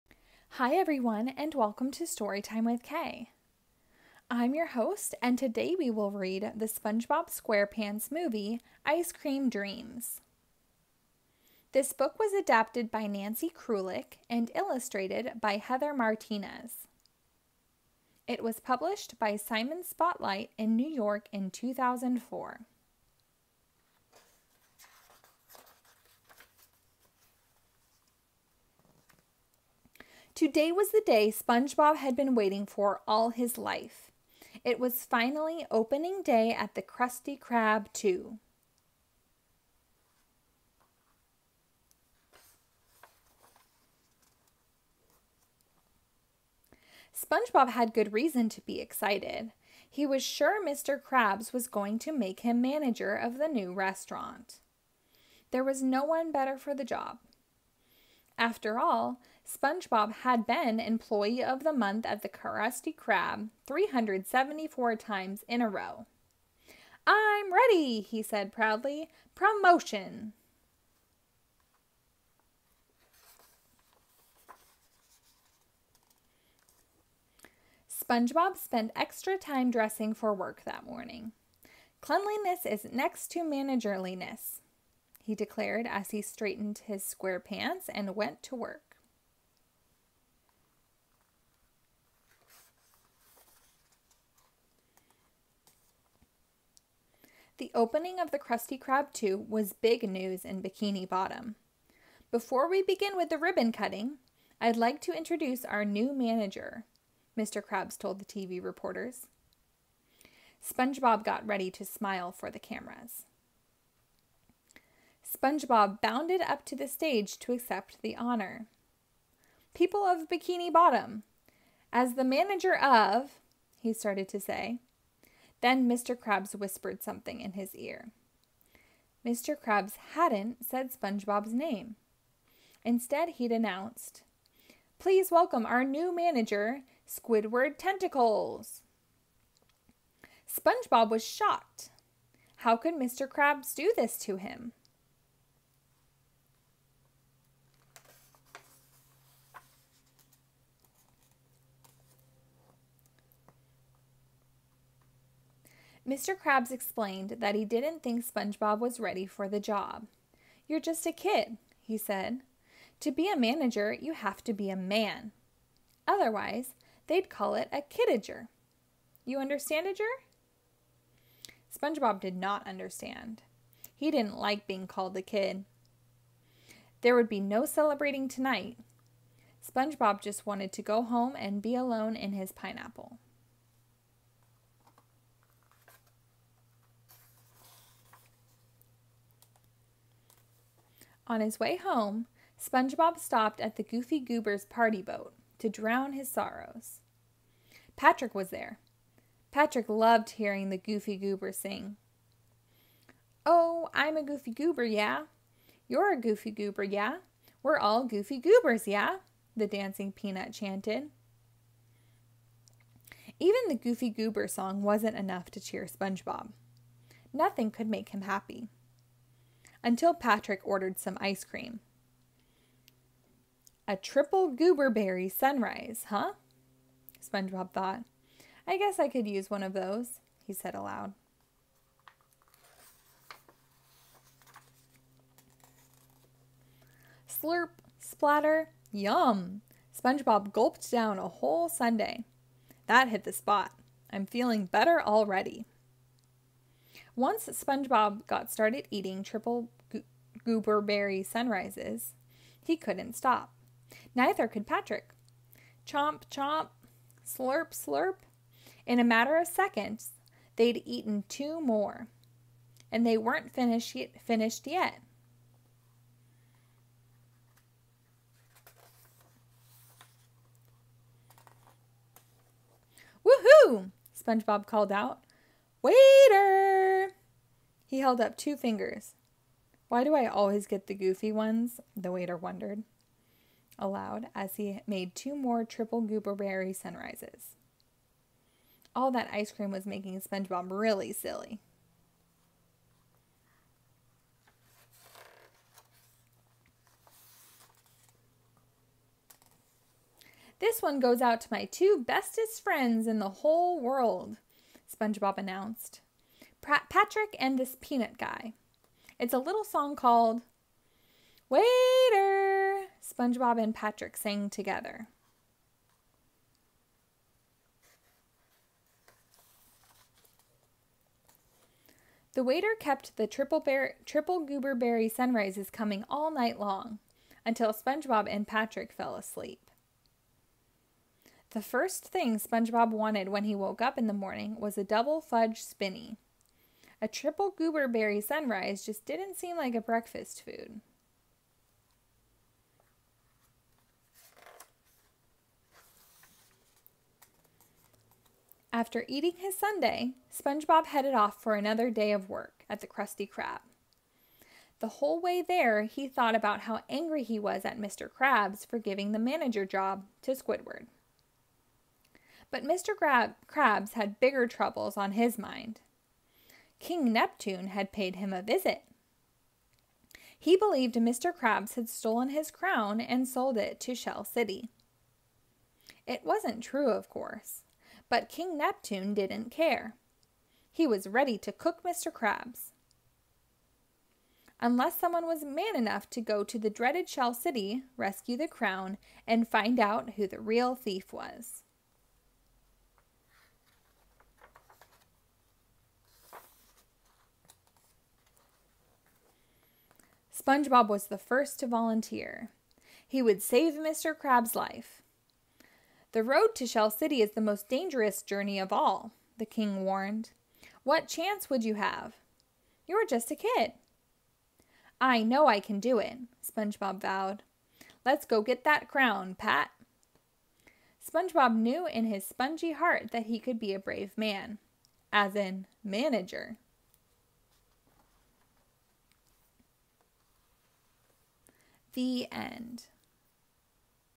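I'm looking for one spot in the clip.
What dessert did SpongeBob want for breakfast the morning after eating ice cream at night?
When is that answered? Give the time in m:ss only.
5:34.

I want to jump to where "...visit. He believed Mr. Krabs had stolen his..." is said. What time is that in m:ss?
6:08.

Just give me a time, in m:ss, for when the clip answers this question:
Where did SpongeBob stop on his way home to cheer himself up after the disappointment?
3:13.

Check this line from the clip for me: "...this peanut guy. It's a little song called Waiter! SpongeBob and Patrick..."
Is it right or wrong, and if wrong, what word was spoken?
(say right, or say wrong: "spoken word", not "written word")
right.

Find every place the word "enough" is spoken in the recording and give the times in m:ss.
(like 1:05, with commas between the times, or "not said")
3:35, 6:25.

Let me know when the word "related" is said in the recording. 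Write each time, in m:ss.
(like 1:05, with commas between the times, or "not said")
not said.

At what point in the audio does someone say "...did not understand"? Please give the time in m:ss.
2:52.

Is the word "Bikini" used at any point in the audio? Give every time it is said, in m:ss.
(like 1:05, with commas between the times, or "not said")
1:40, 2:00.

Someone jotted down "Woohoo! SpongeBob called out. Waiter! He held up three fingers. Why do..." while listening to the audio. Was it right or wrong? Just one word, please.
wrong.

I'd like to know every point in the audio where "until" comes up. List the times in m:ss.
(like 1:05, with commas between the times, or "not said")
3:39, 5:27.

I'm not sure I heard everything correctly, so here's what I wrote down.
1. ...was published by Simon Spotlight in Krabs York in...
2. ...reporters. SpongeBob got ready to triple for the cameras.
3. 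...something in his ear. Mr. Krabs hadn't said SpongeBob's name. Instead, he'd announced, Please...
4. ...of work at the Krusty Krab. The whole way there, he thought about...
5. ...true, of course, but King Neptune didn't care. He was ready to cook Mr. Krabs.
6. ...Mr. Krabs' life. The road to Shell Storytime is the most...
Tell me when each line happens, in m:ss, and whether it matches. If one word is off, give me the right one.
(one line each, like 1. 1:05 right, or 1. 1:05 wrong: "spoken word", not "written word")
1. 0:18 wrong: "New", not "Krabs"
2. 1:48 wrong: "smile", not "triple"
3. 2:07 right
4. 5:52 right
5. 6:16 right
6. 6:43 wrong: "City", not "Storytime".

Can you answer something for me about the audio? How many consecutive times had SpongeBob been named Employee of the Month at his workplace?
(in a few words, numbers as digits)
374.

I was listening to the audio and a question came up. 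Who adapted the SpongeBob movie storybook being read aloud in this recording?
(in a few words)
Nancy Krulik.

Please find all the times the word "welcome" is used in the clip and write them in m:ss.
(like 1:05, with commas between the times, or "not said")
0:01, 2:15.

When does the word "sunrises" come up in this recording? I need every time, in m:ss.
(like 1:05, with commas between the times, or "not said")
3:45, 4:11, 4:46, 5:25, 5:38.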